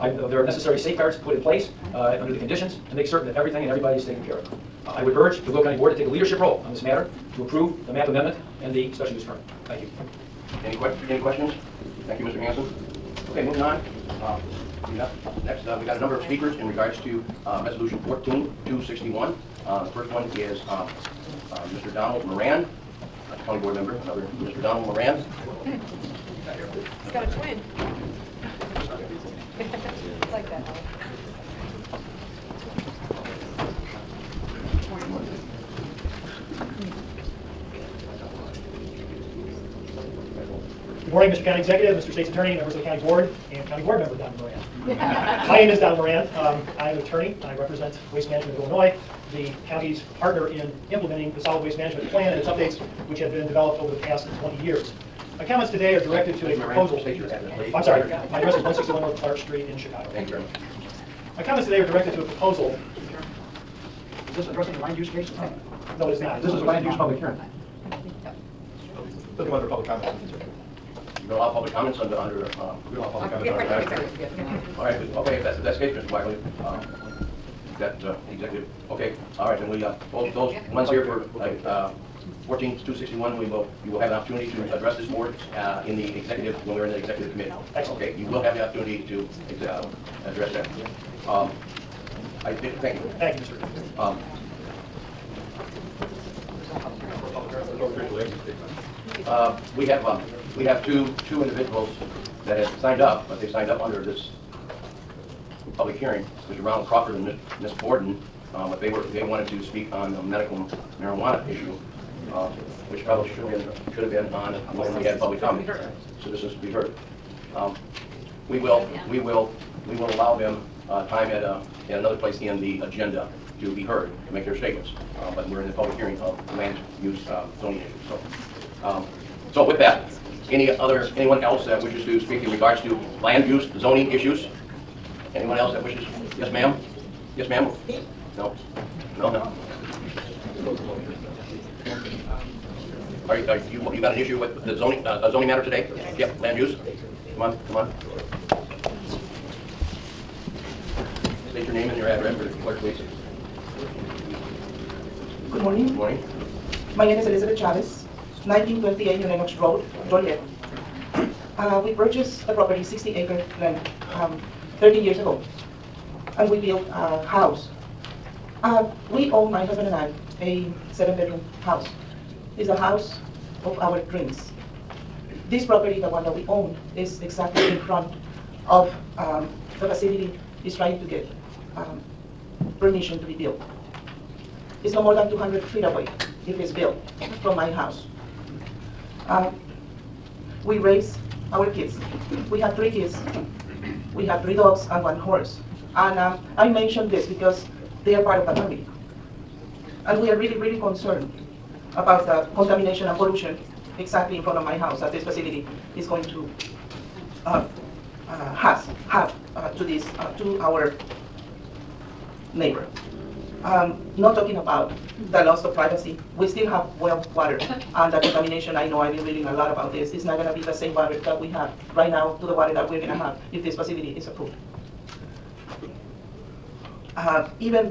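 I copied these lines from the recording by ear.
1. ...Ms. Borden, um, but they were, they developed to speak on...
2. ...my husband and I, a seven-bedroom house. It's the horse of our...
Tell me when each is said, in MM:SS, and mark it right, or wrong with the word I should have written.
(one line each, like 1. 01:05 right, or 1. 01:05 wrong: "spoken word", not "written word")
1. 01:47 wrong: "wanted", not "developed"
2. 02:49 wrong: "house", not "horse".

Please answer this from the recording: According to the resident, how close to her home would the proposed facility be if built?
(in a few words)
200 feet.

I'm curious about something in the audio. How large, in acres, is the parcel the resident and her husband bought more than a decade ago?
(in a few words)
60 acres.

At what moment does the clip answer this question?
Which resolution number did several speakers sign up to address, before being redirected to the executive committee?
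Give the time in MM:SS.
00:18.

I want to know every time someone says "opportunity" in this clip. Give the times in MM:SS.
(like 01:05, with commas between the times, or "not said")
01:24, 01:28.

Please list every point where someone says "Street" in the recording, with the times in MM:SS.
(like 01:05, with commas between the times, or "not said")
00:59.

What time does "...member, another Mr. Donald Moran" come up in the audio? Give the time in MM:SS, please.
00:23.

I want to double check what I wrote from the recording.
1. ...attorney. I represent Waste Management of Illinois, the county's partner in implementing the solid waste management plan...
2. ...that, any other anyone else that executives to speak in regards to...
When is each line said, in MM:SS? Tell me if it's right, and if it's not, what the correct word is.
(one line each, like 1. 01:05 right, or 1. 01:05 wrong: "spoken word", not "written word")
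1. 00:47 right
2. 02:09 wrong: "wishes", not "executives".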